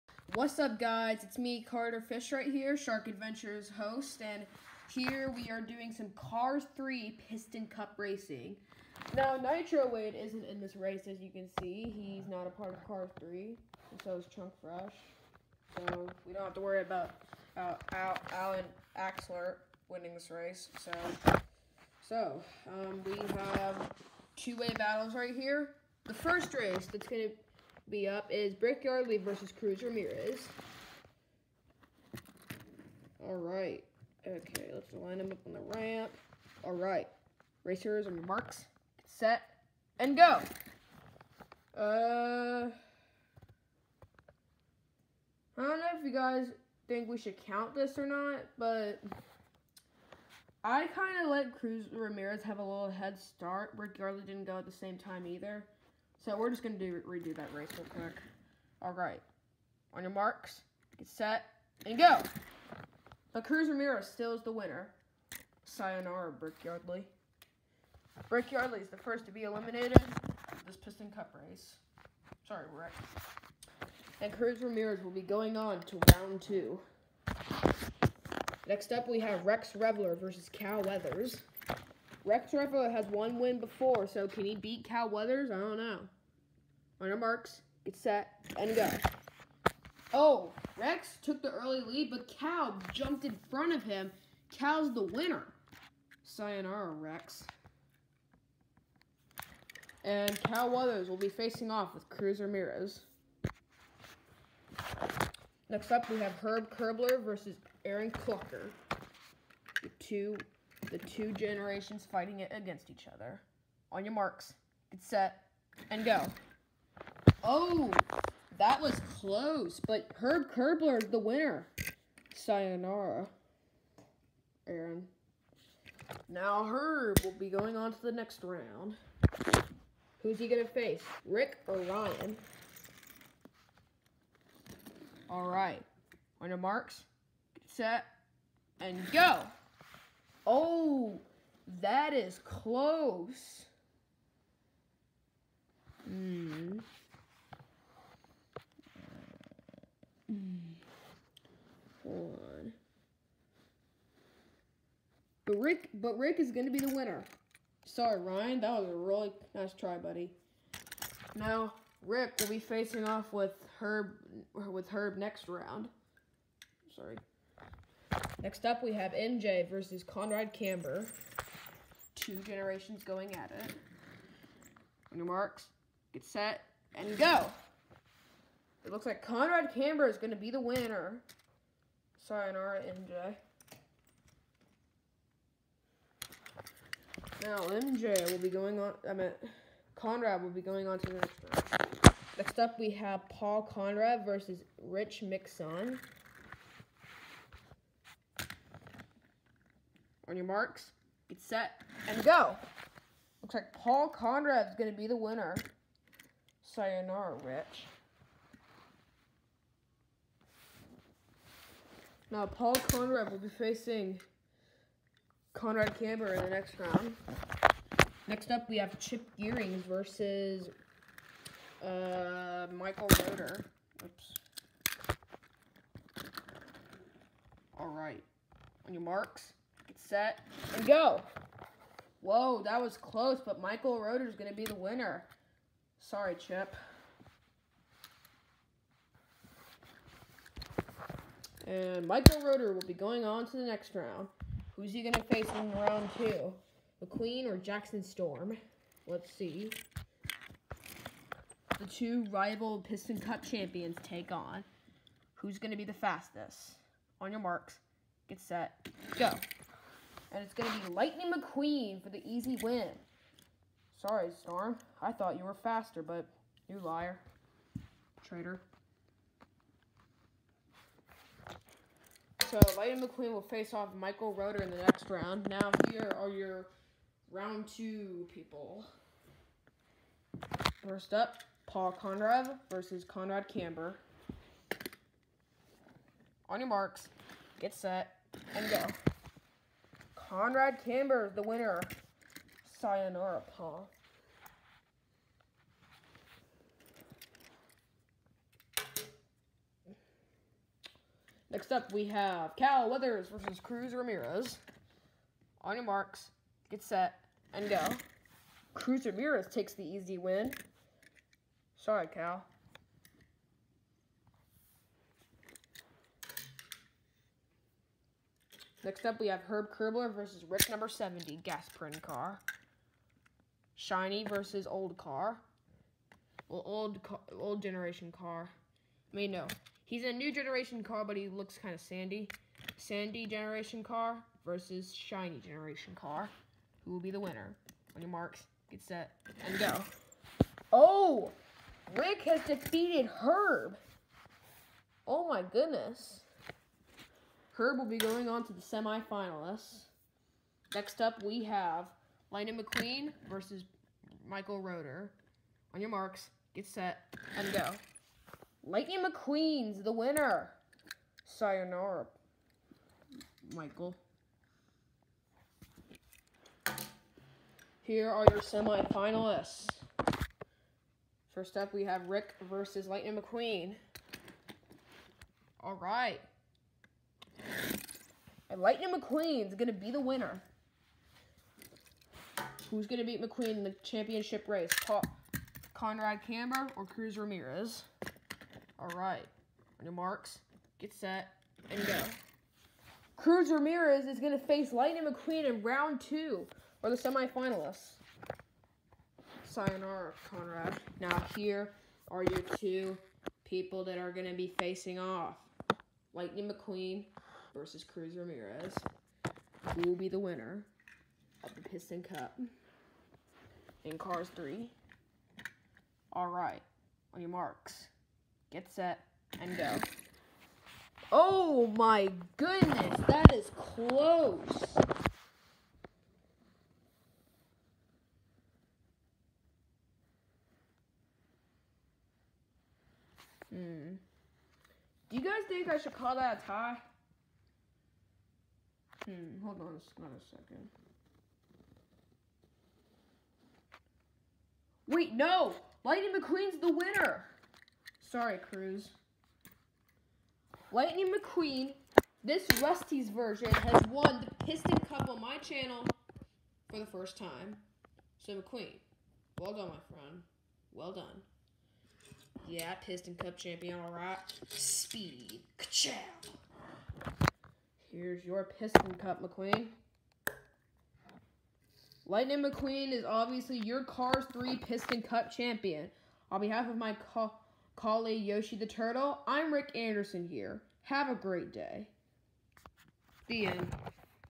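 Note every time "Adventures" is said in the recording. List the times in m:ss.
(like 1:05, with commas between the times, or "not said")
0:03.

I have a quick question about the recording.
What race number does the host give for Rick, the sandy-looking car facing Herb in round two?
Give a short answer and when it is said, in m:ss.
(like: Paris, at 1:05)
70, at 5:20.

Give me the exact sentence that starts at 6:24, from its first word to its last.
Paul Conrad Camber or Cruz Ramirez?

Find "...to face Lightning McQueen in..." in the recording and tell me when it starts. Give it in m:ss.
6:34.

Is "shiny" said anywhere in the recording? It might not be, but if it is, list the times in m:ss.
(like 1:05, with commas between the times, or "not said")
5:23, 5:34.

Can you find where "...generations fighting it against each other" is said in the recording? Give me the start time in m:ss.
1:51.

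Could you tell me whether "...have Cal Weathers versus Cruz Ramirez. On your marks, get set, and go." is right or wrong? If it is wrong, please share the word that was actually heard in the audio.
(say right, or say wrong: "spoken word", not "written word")
right.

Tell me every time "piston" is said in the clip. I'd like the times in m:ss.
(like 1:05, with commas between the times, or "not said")
0:07, 1:10, 4:12, 6:51, 7:34, 7:42, 7:48, 7:54.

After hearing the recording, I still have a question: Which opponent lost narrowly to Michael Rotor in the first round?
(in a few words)
Chip Gearing.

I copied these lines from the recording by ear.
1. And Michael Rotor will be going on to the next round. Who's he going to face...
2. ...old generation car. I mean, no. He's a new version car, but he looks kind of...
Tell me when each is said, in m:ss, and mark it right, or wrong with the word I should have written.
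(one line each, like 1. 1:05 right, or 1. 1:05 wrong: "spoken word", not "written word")
1. 4:01 right
2. 5:27 wrong: "generation", not "version".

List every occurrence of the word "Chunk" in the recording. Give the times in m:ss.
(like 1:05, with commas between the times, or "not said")
0:14.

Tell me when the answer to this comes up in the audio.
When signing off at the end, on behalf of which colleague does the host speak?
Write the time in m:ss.
7:58.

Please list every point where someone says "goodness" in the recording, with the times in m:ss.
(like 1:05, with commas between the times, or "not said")
5:45, 7:02.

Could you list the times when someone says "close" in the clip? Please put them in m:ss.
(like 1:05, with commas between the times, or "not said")
1:59, 2:22, 3:52, 7:03.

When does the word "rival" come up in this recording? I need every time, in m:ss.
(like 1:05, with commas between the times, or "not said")
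4:12.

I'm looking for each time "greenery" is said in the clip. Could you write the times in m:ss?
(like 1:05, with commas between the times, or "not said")
not said.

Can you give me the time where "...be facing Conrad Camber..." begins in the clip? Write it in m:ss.
3:33.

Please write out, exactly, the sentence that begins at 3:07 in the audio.
Now, MJ will be going on, I meant, Conrad will be going on to the next round.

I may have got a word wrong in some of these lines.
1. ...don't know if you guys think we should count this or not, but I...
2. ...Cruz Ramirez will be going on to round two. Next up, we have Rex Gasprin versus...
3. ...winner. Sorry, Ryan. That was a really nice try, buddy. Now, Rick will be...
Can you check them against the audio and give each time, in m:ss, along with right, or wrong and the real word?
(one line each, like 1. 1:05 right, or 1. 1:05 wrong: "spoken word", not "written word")
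1. 0:45 right
2. 1:14 wrong: "Revler", not "Gasprin"
3. 2:36 right.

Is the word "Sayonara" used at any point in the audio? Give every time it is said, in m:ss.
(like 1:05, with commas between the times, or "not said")
1:05, 1:36, 2:02, 3:02, 3:26, 4:52, 6:01, 6:39.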